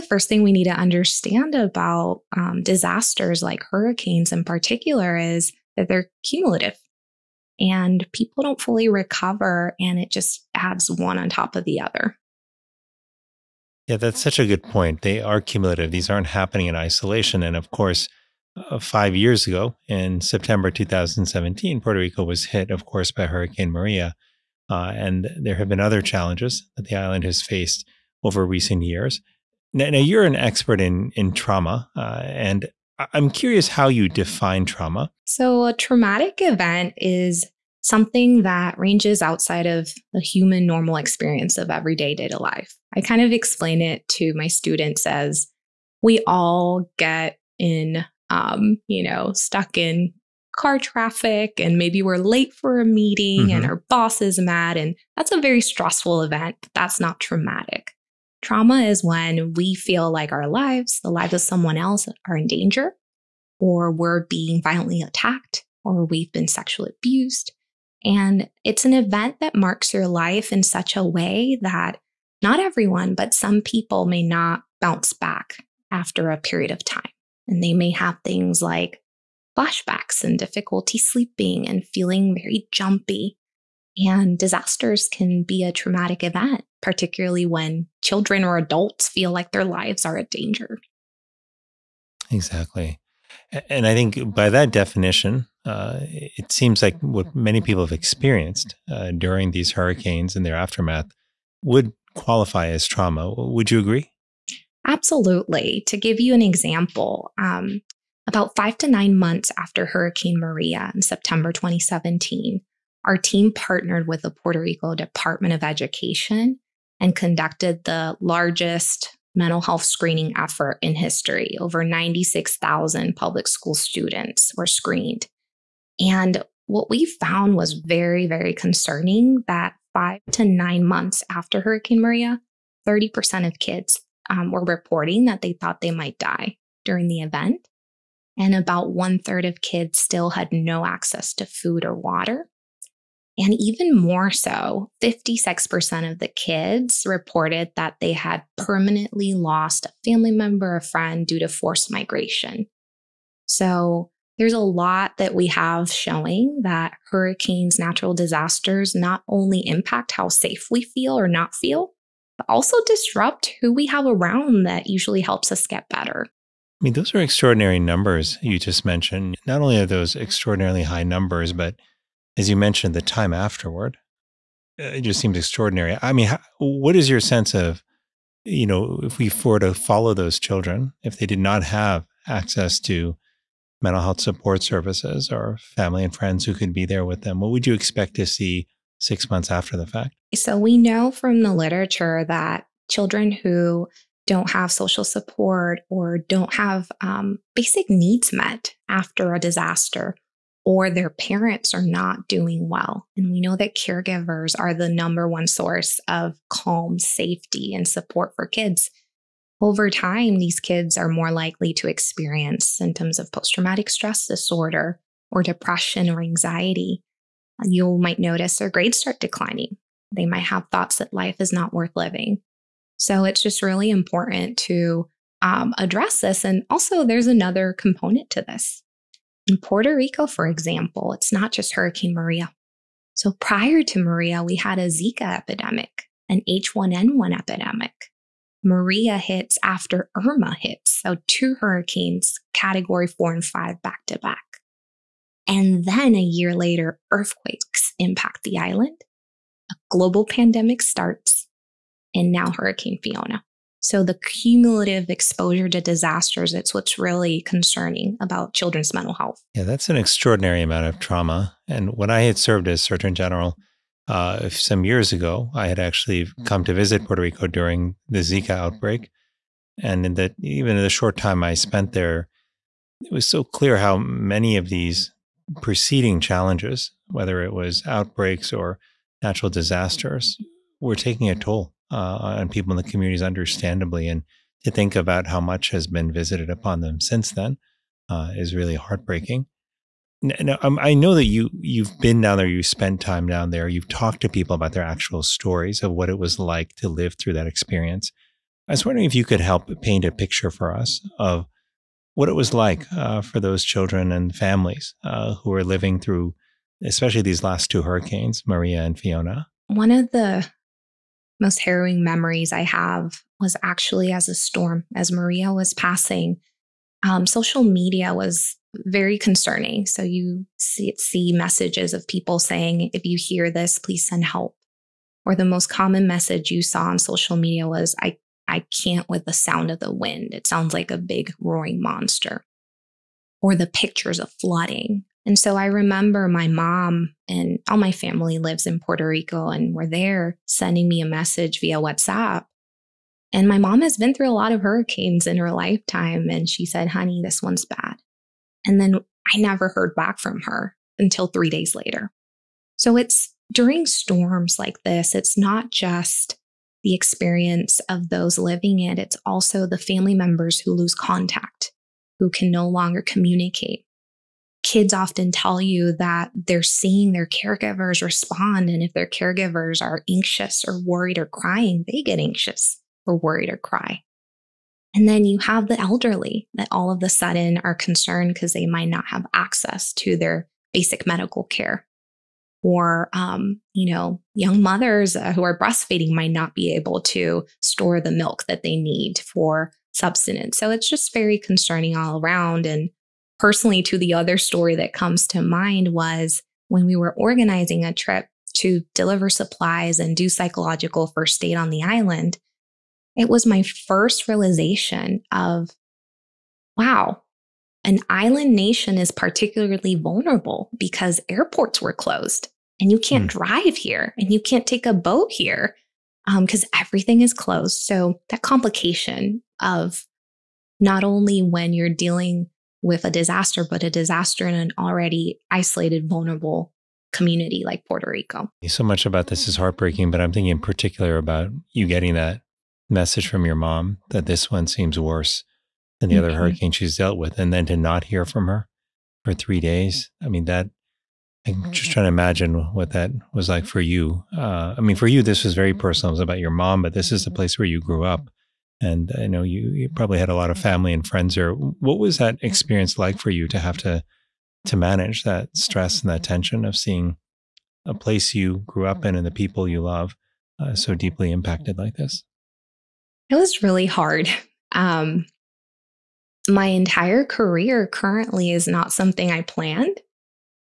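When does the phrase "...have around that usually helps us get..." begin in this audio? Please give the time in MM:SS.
02:43.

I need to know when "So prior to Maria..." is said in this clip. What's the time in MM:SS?
03:53.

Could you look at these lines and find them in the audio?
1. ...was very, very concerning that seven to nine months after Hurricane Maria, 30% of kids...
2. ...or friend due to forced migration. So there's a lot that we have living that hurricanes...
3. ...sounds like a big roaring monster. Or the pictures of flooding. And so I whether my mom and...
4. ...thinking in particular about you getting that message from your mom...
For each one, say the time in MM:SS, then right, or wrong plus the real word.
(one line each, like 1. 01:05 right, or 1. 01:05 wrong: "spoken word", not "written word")
1. 02:07 wrong: "five", not "seven"
2. 02:30 wrong: "showing", not "living"
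3. 05:30 wrong: "remember", not "whether"
4. 07:10 right.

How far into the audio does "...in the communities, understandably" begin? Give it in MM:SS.
04:42.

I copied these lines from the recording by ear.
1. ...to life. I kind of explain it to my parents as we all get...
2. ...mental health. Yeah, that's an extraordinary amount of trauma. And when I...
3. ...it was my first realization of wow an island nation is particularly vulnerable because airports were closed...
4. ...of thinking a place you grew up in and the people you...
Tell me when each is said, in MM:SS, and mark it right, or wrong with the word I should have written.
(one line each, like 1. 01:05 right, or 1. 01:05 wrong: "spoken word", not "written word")
1. 00:42 wrong: "students", not "parents"
2. 04:18 right
3. 06:43 right
4. 07:36 wrong: "seeing", not "thinking".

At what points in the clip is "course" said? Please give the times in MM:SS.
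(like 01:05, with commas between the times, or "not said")
00:17, 00:22.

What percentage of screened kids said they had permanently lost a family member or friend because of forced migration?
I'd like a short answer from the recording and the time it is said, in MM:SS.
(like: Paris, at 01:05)
56%, at 02:25.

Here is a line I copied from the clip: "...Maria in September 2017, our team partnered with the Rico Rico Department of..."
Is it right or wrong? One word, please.
wrong.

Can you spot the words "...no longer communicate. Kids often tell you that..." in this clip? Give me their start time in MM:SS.
06:02.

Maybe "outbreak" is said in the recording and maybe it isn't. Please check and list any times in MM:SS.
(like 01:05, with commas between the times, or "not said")
04:28, 04:37.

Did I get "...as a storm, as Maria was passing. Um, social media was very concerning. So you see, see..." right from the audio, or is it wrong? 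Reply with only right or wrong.
right.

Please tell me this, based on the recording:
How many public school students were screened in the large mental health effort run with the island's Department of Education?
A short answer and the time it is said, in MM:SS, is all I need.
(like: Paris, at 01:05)
Over 96,000, at 02:01.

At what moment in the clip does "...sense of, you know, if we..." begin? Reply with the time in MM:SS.
02:57.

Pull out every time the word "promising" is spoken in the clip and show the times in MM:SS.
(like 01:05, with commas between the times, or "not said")
not said.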